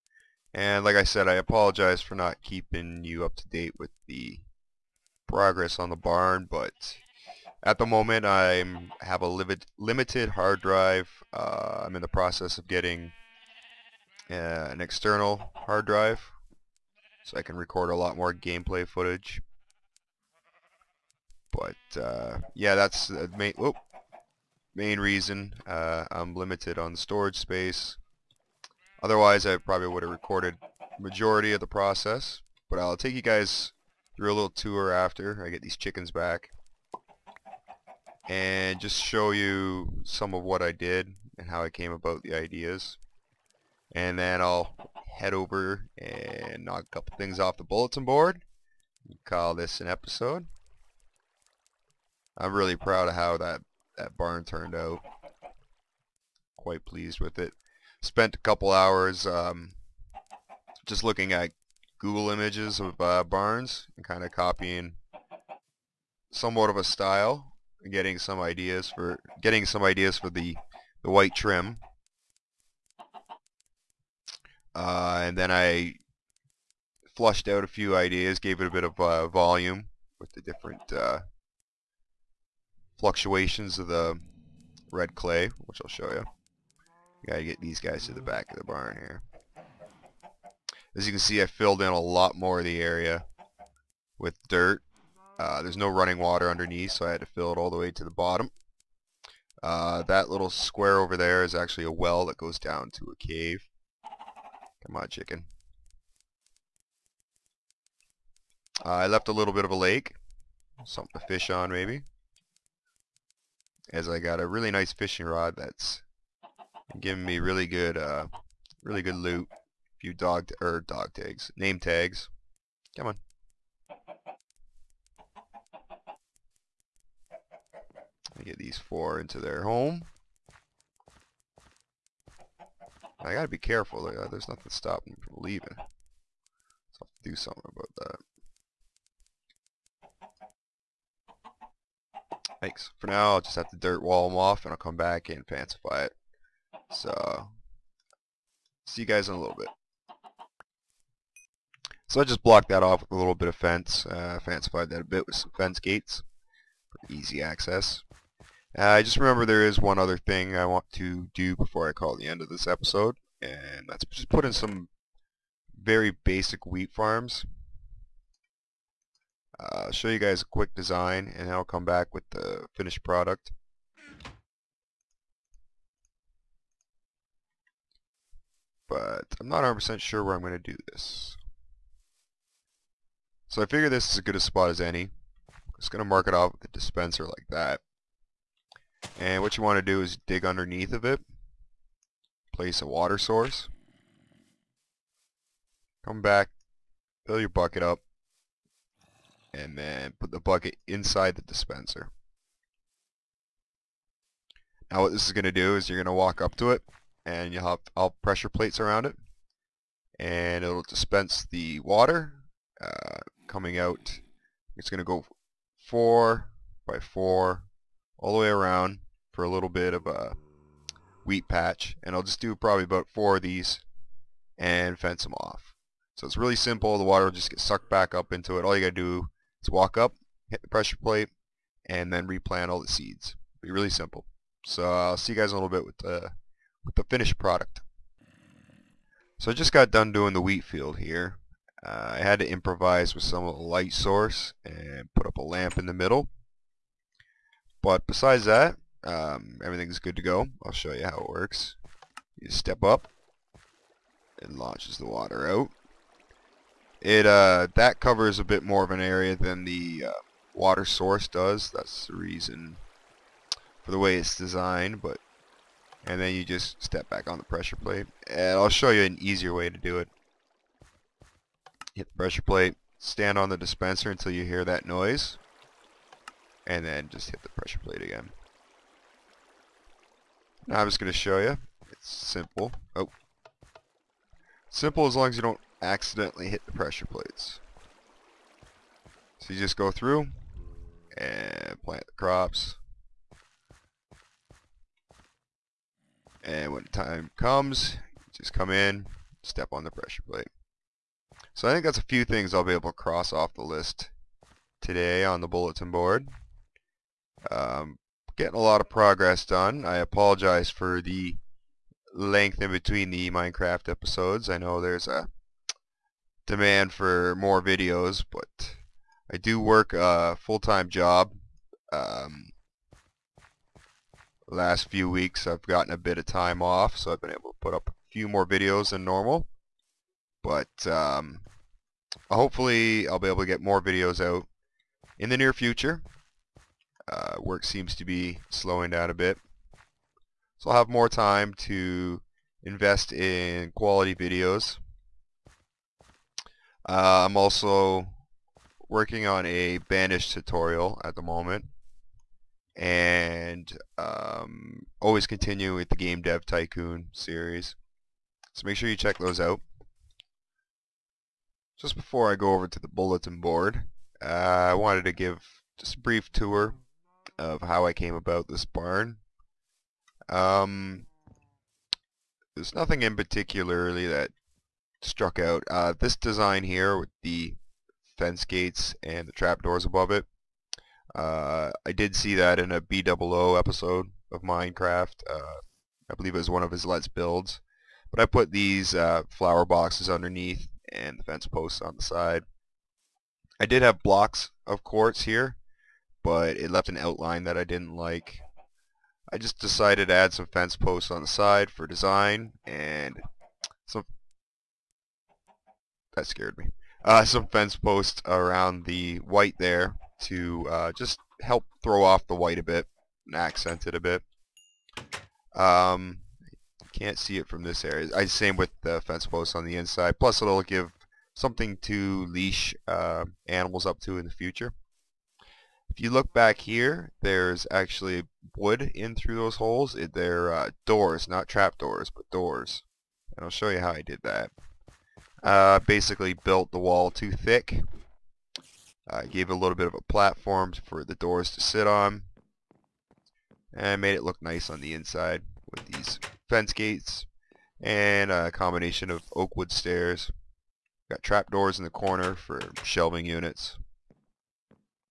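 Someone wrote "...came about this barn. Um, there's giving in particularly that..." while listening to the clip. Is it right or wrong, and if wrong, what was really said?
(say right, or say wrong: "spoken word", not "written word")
wrong: "nothing", not "giving".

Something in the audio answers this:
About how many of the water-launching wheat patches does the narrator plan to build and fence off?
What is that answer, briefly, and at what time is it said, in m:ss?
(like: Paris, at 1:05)
4, at 3:42.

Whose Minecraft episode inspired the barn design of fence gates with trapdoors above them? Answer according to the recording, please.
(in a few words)
BdoubleO.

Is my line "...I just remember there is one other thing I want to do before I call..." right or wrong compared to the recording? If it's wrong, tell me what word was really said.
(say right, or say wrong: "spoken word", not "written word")
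right.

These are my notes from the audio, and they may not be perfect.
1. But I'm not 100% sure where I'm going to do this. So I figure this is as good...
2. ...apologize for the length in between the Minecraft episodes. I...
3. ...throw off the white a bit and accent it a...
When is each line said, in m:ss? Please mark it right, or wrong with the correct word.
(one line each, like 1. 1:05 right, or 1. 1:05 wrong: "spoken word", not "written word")
1. 2:58 right
2. 5:09 right
3. 6:51 right.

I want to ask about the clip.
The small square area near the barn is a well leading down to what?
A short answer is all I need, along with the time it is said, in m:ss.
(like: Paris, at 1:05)
a cave, at 1:43.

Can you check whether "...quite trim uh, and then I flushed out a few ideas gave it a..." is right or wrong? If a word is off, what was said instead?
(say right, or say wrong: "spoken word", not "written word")
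wrong: "white", not "quite".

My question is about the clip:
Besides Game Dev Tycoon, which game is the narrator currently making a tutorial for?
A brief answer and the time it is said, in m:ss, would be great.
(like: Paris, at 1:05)
Banished, at 5:49.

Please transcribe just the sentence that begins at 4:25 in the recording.
But And then you just step back on the pressure plate.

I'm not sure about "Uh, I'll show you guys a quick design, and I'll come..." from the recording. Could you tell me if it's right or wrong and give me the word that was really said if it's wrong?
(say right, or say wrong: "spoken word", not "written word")
right.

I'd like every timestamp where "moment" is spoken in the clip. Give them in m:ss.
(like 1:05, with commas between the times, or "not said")
0:07, 5:51.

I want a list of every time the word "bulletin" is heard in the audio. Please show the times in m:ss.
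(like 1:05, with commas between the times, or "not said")
0:47, 5:05, 6:02.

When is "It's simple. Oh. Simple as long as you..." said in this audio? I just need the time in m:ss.
4:41.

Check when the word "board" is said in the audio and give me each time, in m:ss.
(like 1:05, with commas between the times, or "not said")
0:48, 5:05, 6:03.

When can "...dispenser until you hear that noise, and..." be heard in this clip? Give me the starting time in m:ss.
4:33.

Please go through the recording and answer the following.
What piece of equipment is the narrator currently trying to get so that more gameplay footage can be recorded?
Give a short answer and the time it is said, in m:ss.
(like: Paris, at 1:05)
external hard drive, at 0:14.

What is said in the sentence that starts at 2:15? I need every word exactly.
So I'll do something about that.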